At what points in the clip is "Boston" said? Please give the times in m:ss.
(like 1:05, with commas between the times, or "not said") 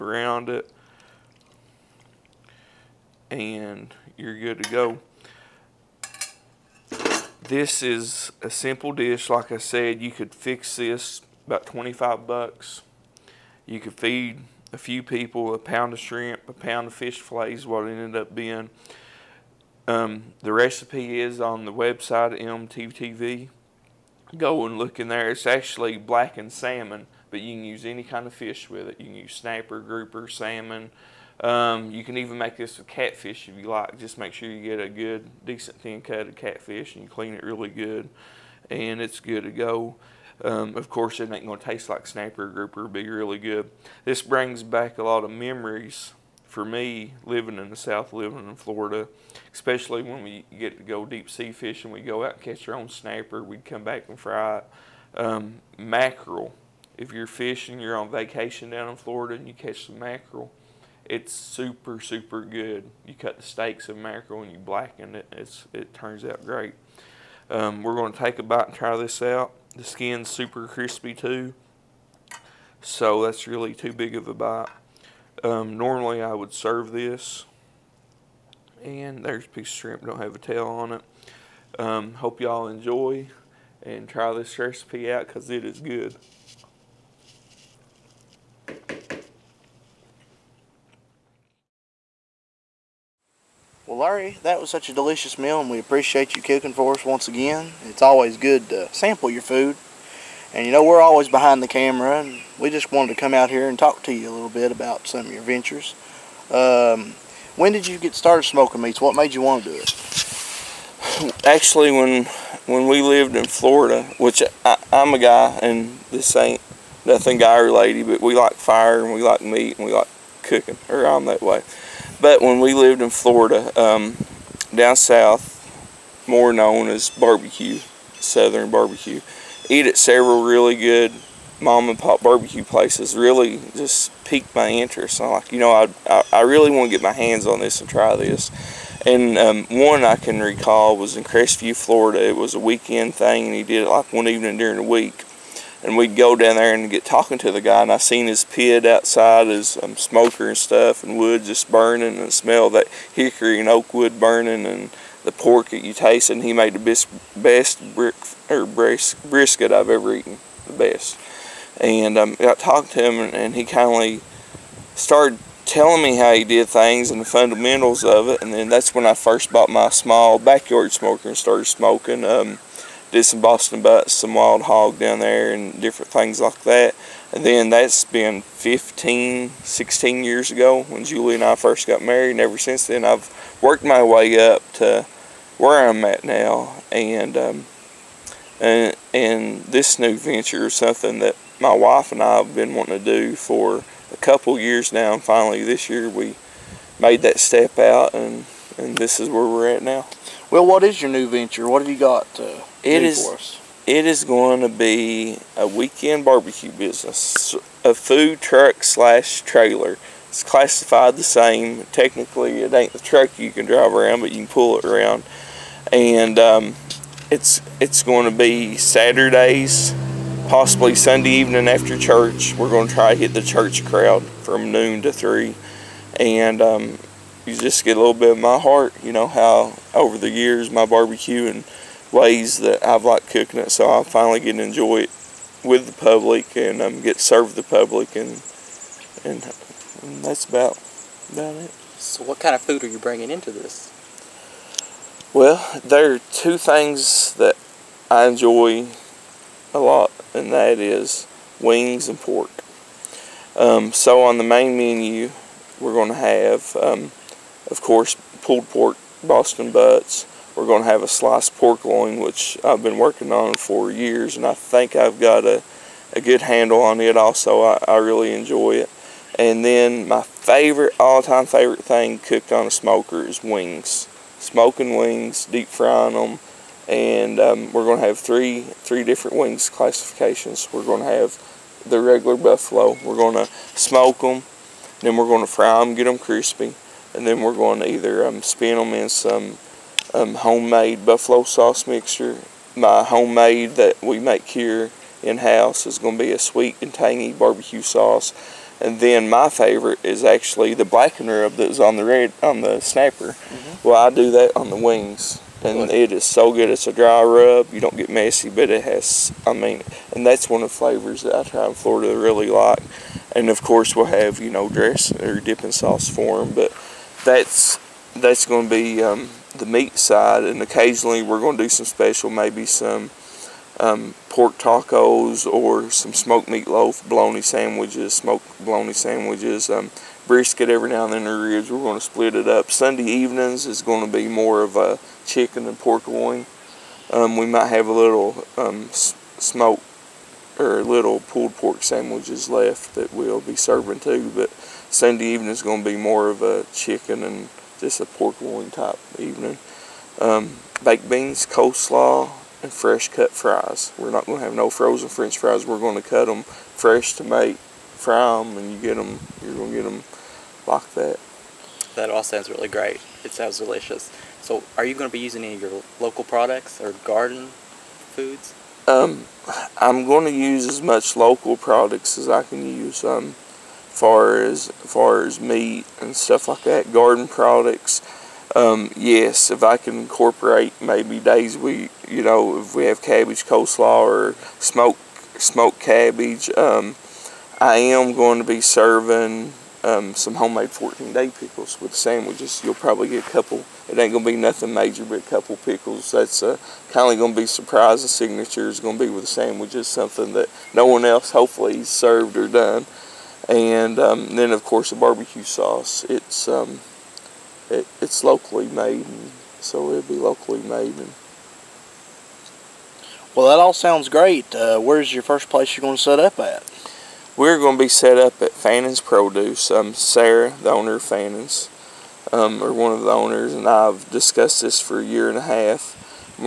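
2:53, 4:19.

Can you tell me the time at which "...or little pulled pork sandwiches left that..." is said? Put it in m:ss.
5:40.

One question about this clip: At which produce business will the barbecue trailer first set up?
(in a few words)
Fannin's Produce.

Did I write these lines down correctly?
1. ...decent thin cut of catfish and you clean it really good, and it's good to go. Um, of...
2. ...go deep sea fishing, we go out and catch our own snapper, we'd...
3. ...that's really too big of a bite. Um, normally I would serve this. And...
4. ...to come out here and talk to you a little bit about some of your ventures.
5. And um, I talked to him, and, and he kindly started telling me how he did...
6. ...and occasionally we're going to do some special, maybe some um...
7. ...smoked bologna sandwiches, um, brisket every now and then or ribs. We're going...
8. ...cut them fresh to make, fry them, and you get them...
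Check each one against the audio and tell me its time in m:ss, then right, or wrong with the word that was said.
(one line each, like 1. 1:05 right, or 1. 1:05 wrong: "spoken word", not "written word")
1. 0:35 right
2. 0:50 right
3. 1:13 right
4. 1:43 right
5. 2:41 right
6. 5:20 right
7. 5:28 right
8. 5:56 right.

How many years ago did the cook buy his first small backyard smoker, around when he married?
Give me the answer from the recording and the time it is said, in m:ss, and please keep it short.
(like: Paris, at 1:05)
15 or 16 years, at 2:58.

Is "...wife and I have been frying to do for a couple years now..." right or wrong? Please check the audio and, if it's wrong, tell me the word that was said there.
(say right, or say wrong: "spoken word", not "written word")
wrong: "wanting", not "frying".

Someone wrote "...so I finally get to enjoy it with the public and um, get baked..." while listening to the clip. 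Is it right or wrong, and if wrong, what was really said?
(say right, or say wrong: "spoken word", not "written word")
wrong: "served", not "baked".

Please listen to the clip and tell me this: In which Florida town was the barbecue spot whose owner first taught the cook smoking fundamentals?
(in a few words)
Crestview.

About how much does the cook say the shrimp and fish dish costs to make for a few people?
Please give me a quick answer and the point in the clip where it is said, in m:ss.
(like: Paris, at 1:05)
$25, at 0:11.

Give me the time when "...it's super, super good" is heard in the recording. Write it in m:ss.
1:01.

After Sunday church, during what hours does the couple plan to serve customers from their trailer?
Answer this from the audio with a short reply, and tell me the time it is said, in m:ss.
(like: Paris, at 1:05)
Noon to 3, at 3:44.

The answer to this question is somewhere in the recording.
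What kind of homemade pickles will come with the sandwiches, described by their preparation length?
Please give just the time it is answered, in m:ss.
6:30.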